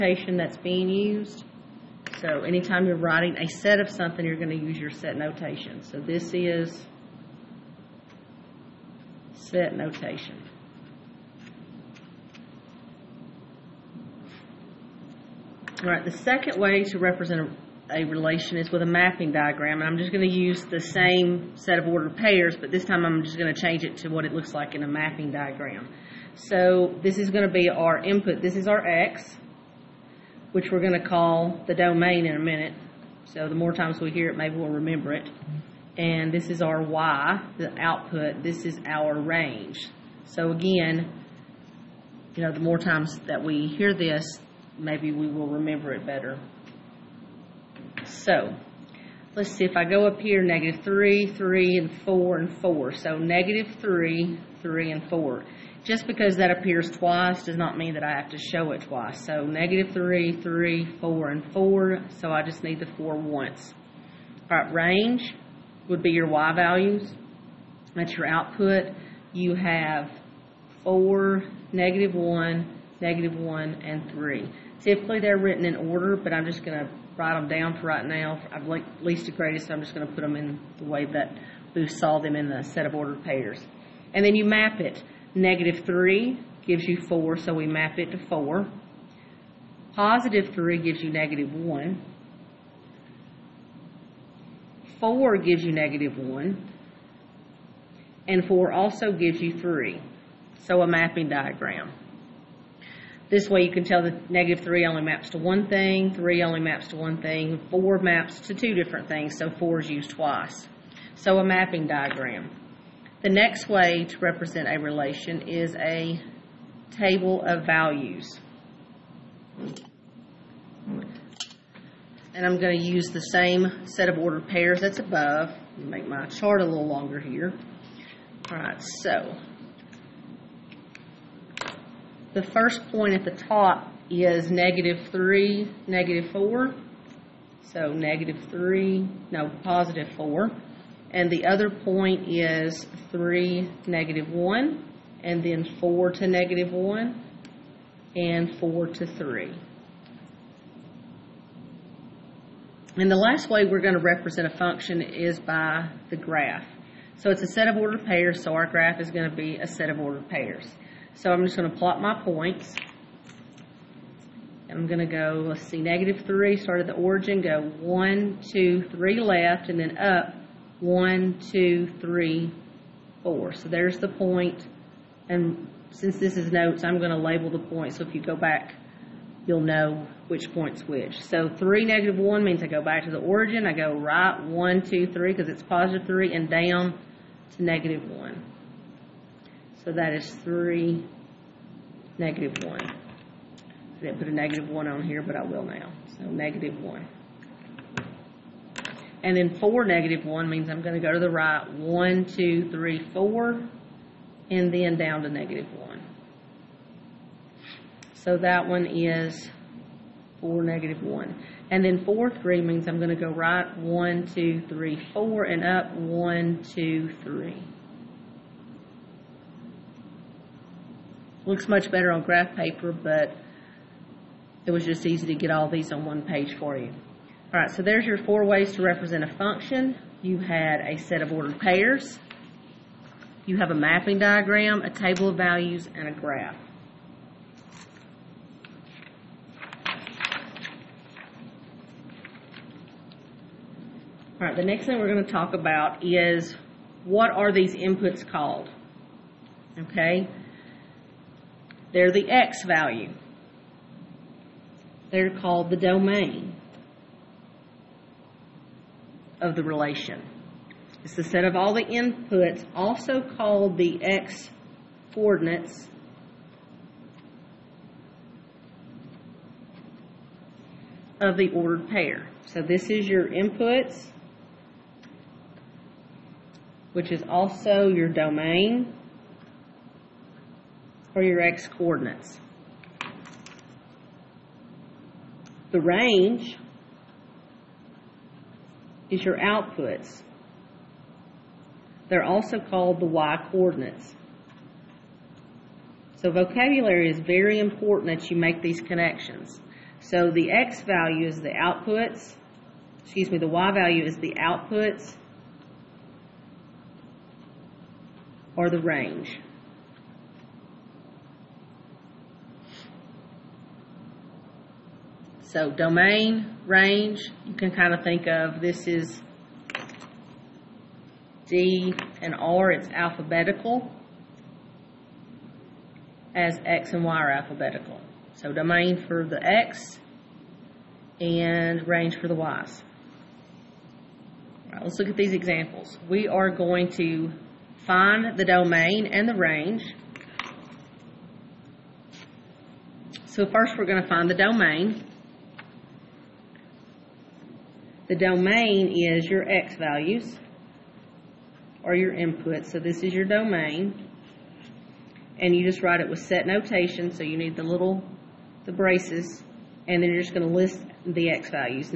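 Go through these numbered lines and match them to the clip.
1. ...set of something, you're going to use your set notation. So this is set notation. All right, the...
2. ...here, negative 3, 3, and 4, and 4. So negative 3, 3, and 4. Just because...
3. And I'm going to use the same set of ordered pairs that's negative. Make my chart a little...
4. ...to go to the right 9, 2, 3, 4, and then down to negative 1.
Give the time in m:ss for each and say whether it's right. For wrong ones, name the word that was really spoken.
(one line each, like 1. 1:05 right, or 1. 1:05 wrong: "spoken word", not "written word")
1. 0:03 right
2. 0:50 right
3. 2:02 wrong: "above", not "negative"
4. 3:20 wrong: "1", not "9".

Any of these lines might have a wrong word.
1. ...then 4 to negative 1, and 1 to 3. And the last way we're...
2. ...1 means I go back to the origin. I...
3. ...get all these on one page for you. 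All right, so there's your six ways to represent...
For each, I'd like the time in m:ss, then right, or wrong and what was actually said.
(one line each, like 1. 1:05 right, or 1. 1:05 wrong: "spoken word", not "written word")
1. 2:25 wrong: "4", not "1"
2. 3:02 right
3. 3:45 wrong: "four", not "six".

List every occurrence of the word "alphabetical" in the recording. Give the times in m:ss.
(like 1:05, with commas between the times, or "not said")
5:22, 5:27.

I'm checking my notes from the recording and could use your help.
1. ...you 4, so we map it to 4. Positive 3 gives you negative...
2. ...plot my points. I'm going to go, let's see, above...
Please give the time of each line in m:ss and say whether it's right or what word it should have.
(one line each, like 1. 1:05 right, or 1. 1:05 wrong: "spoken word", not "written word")
1. 1:26 right
2. 2:41 wrong: "negative", not "above".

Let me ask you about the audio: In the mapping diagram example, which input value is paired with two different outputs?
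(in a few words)
4.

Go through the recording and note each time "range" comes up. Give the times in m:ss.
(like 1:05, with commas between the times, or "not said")
0:39, 1:04, 4:45, 5:08, 5:16, 5:31, 5:39.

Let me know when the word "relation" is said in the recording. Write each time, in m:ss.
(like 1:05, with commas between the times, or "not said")
0:18, 1:54, 4:19.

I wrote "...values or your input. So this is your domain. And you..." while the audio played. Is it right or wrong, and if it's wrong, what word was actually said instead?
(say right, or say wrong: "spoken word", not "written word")
right.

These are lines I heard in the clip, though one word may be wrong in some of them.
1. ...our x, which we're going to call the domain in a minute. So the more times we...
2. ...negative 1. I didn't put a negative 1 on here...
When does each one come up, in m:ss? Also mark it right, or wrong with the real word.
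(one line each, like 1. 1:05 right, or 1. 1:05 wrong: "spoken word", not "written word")
1. 0:28 right
2. 3:12 right.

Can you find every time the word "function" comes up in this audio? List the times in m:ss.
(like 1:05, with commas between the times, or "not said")
2:34, 3:49.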